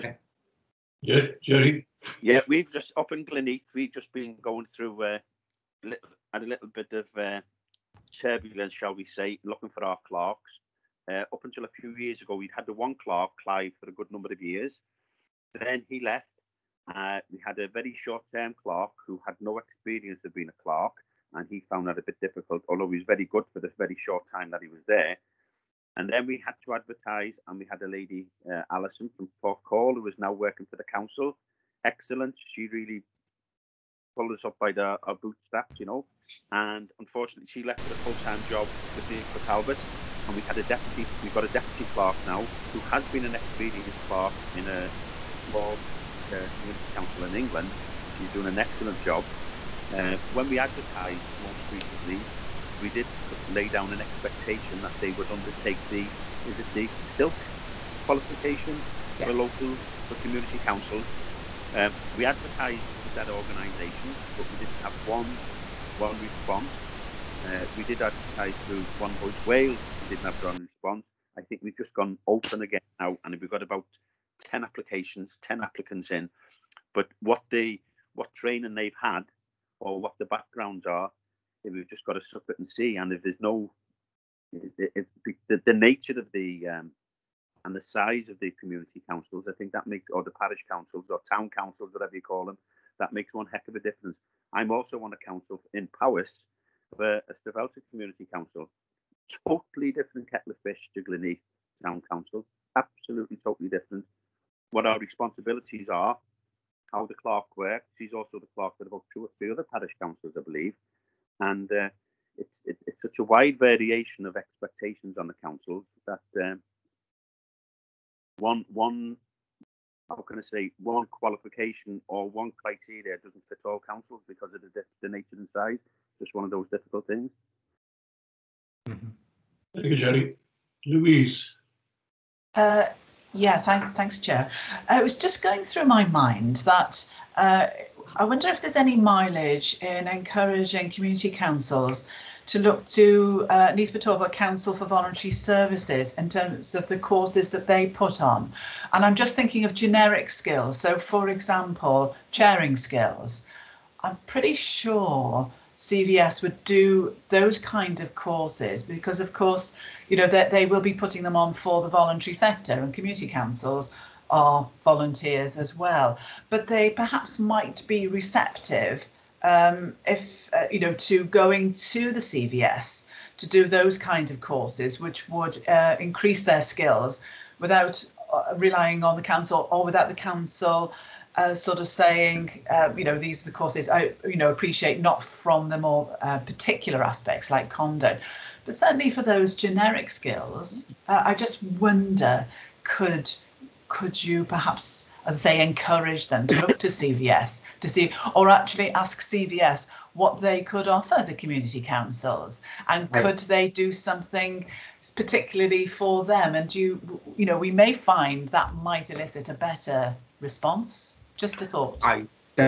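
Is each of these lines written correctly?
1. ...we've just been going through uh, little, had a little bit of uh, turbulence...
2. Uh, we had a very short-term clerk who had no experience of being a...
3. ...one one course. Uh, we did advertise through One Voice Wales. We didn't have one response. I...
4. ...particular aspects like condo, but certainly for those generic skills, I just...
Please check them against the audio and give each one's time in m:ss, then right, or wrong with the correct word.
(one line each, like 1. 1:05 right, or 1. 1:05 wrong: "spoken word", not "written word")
1. 0:03 right
2. 0:16 right
3. 1:05 wrong: "response", not "course"
4. 3:06 right.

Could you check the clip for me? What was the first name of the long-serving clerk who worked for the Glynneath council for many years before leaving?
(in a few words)
Clive.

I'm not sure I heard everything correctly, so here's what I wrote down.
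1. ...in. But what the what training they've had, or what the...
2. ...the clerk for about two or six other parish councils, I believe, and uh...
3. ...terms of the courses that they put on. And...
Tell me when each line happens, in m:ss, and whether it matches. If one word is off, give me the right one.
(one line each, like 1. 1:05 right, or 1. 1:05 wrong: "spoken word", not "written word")
1. 1:16 right
2. 1:48 wrong: "three", not "six"
3. 2:26 right.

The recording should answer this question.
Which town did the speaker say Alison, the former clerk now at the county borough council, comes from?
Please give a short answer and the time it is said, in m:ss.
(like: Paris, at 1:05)
Porthcawl, at 0:29.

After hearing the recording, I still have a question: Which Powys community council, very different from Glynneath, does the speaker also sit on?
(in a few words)
Stavelton.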